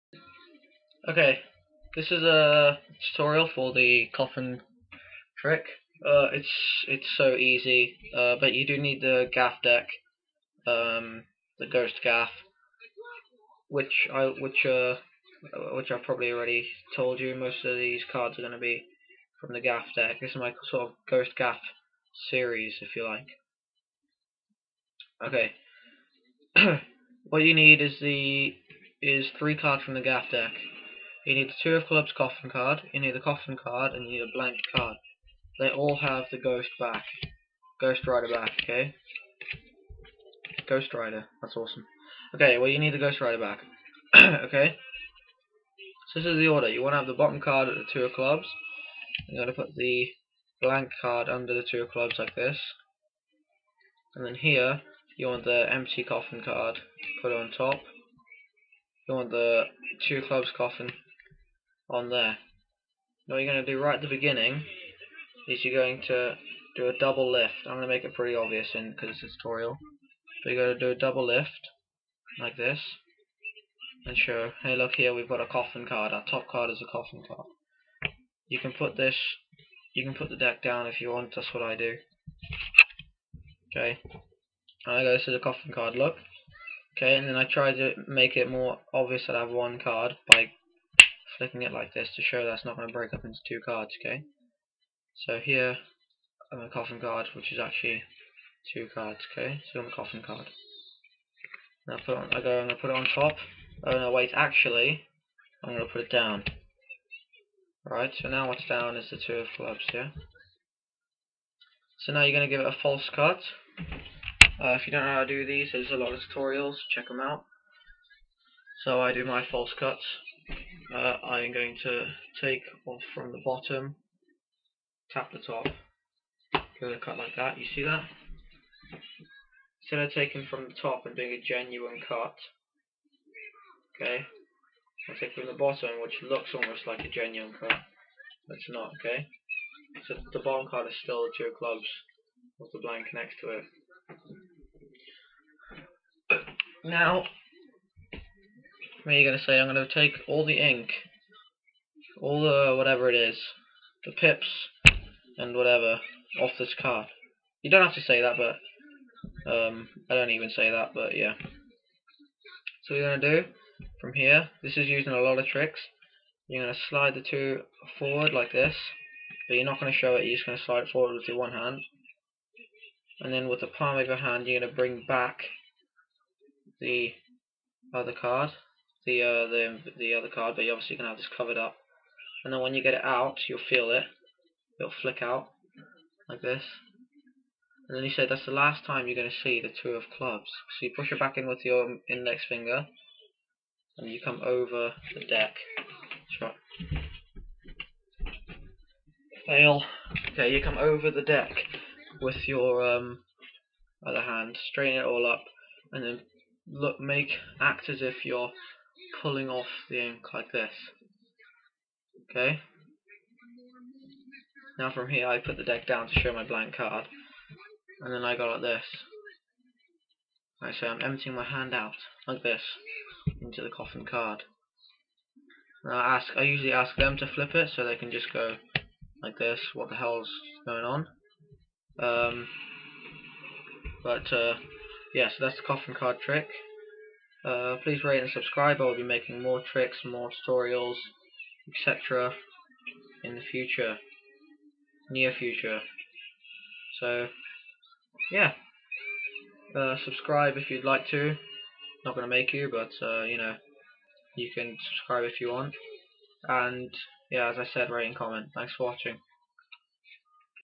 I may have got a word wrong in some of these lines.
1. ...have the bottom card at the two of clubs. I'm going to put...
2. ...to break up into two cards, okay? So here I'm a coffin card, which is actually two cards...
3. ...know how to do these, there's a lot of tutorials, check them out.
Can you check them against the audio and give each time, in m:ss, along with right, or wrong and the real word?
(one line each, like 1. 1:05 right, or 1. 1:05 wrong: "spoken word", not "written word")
1. 0:46 right
2. 1:32 right
3. 1:55 right.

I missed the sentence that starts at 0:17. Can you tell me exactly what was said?
Most of these cards are going to be from the gaff deck.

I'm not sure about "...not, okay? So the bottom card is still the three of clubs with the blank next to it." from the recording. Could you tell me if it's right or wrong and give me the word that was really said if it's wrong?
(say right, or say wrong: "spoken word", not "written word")
wrong: "two", not "three".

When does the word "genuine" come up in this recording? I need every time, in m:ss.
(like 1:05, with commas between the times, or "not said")
2:11, 2:17.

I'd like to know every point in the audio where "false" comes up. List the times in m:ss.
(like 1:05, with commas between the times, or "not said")
1:52, 1:59.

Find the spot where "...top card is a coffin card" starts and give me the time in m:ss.
1:16.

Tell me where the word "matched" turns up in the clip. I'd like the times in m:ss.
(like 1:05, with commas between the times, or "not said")
not said.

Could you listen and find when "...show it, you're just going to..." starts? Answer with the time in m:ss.
2:49.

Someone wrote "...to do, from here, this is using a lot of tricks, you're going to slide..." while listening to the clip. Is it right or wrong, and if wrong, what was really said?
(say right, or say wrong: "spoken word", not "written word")
right.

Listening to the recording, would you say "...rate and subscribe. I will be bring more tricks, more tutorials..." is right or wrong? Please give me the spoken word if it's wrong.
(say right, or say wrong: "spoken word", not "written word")
wrong: "making", not "bring".